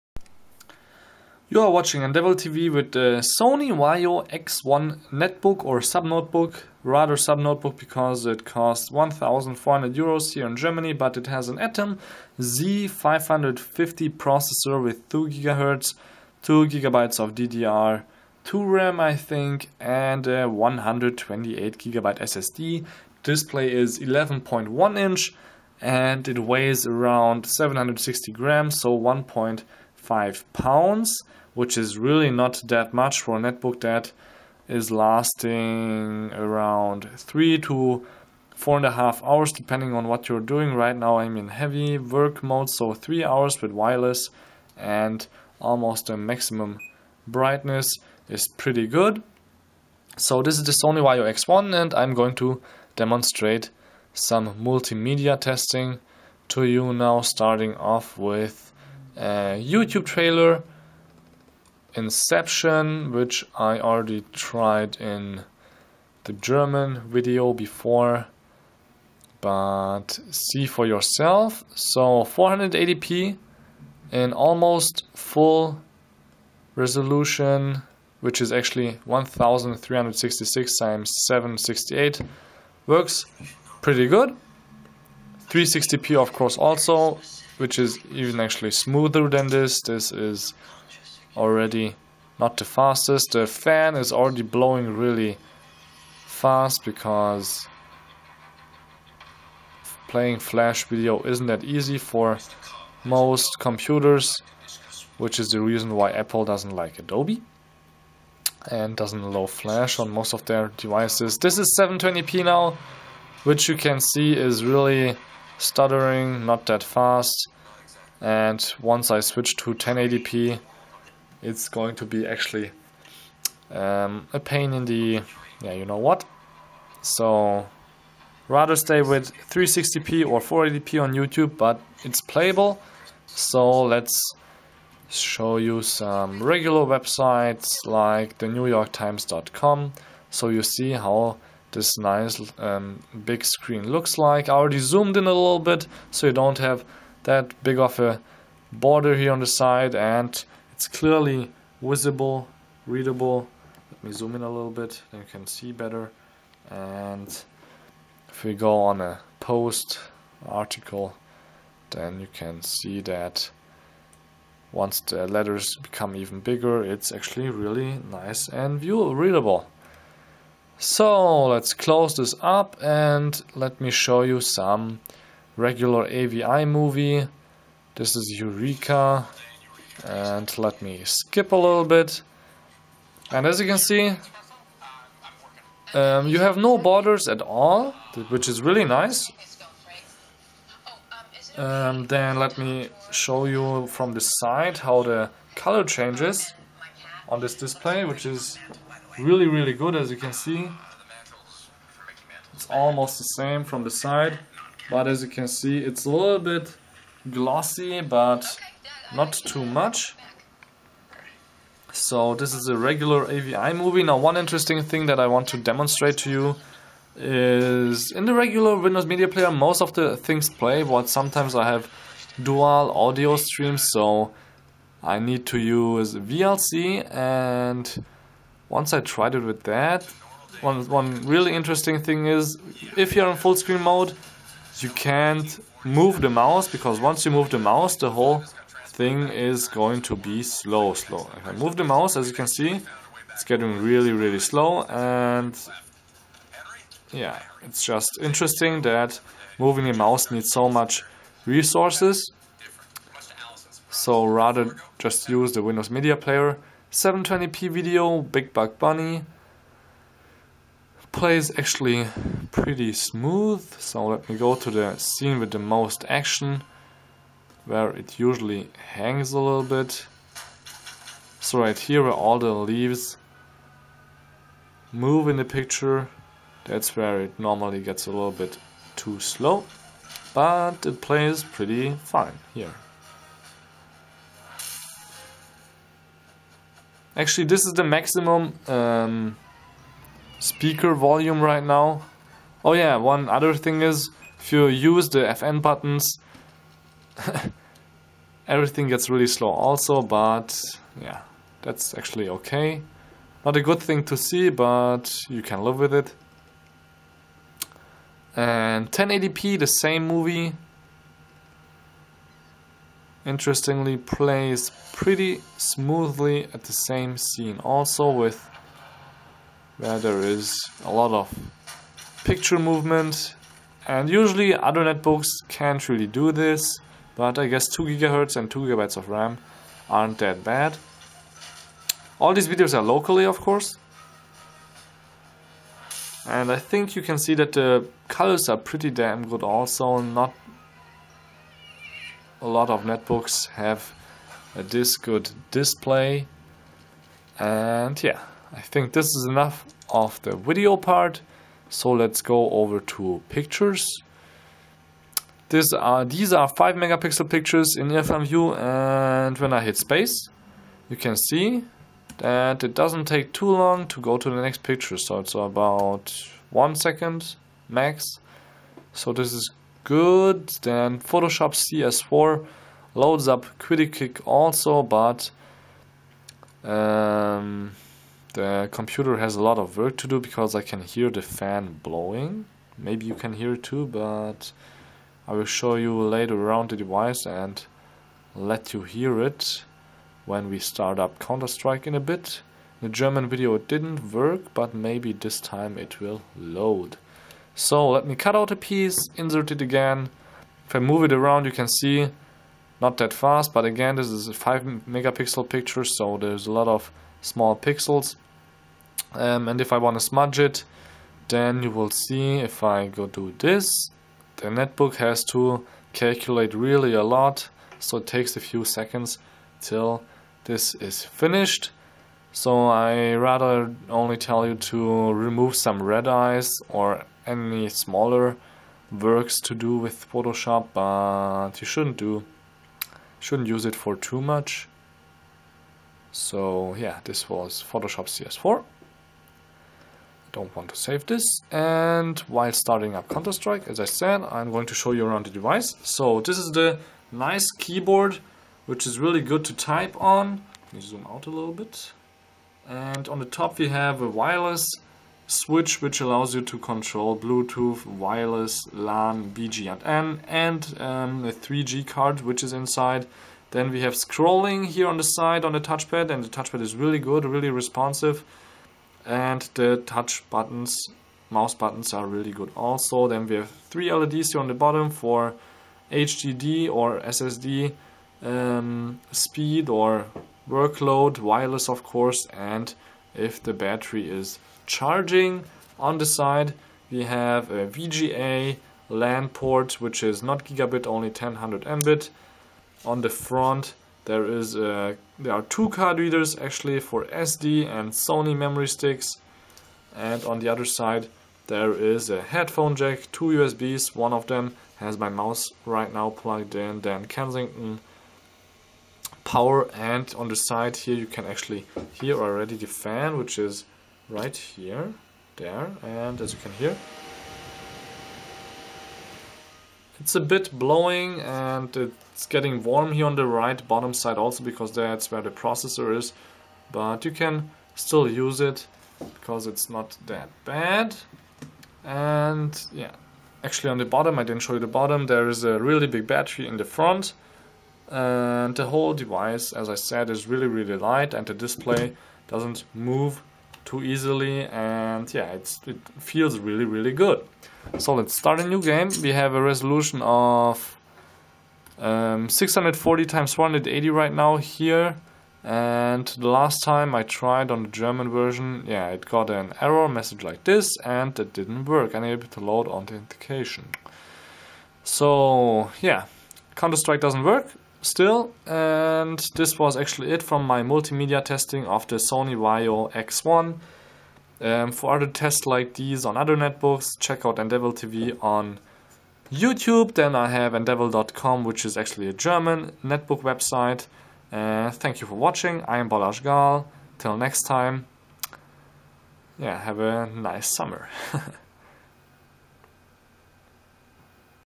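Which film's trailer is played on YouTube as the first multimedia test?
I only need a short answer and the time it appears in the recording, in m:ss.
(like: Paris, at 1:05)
Inception, at 1:01.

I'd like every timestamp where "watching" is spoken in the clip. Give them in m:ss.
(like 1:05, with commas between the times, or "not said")
0:01, 9:45.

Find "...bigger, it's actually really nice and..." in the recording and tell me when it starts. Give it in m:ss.
2:46.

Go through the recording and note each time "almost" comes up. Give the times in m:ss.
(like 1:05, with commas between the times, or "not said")
0:45, 1:14, 3:22.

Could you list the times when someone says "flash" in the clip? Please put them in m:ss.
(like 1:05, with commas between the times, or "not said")
1:40, 1:49.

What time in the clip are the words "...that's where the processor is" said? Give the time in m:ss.
8:44.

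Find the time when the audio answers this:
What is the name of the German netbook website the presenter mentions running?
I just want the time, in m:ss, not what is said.
9:40.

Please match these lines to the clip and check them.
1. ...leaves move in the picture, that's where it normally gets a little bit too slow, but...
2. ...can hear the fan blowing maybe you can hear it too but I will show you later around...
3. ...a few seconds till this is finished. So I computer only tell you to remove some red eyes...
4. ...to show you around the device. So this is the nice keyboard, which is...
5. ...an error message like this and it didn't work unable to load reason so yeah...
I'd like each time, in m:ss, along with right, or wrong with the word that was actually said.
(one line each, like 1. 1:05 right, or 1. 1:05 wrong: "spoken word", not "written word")
1. 4:32 right
2. 6:20 right
3. 6:58 wrong: "rather", not "computer"
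4. 7:24 right
5. 9:19 wrong: "authentication", not "reason".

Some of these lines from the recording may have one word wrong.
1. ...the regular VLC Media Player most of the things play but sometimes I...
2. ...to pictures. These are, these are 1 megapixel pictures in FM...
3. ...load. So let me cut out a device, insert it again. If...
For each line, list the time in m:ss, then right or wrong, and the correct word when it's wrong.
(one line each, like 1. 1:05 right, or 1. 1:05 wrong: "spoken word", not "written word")
1. 3:38 wrong: "Windows", not "VLC"
2. 5:52 wrong: "5", not "1"
3. 6:36 wrong: "piece", not "device".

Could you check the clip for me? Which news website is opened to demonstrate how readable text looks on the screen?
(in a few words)
newyorktimes.com.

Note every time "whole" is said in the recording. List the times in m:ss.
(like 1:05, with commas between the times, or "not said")
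3:58, 8:58.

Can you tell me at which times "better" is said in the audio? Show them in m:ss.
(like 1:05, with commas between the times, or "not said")
2:35.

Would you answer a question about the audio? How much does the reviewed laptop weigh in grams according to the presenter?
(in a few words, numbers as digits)
760 grams.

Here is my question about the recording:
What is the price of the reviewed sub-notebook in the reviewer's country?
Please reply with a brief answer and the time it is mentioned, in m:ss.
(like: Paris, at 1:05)
1400 euros, at 0:08.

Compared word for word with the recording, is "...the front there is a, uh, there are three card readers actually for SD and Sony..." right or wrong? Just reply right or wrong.
wrong.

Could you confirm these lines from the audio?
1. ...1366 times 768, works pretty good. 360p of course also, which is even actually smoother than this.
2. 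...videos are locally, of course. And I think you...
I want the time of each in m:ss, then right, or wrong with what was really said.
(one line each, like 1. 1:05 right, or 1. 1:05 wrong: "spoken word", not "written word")
1. 1:19 right
2. 5:32 right.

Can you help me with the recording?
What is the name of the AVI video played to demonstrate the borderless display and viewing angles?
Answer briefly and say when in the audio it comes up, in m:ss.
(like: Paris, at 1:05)
Eureka, at 2:58.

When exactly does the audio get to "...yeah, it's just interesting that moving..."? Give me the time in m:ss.
4:07.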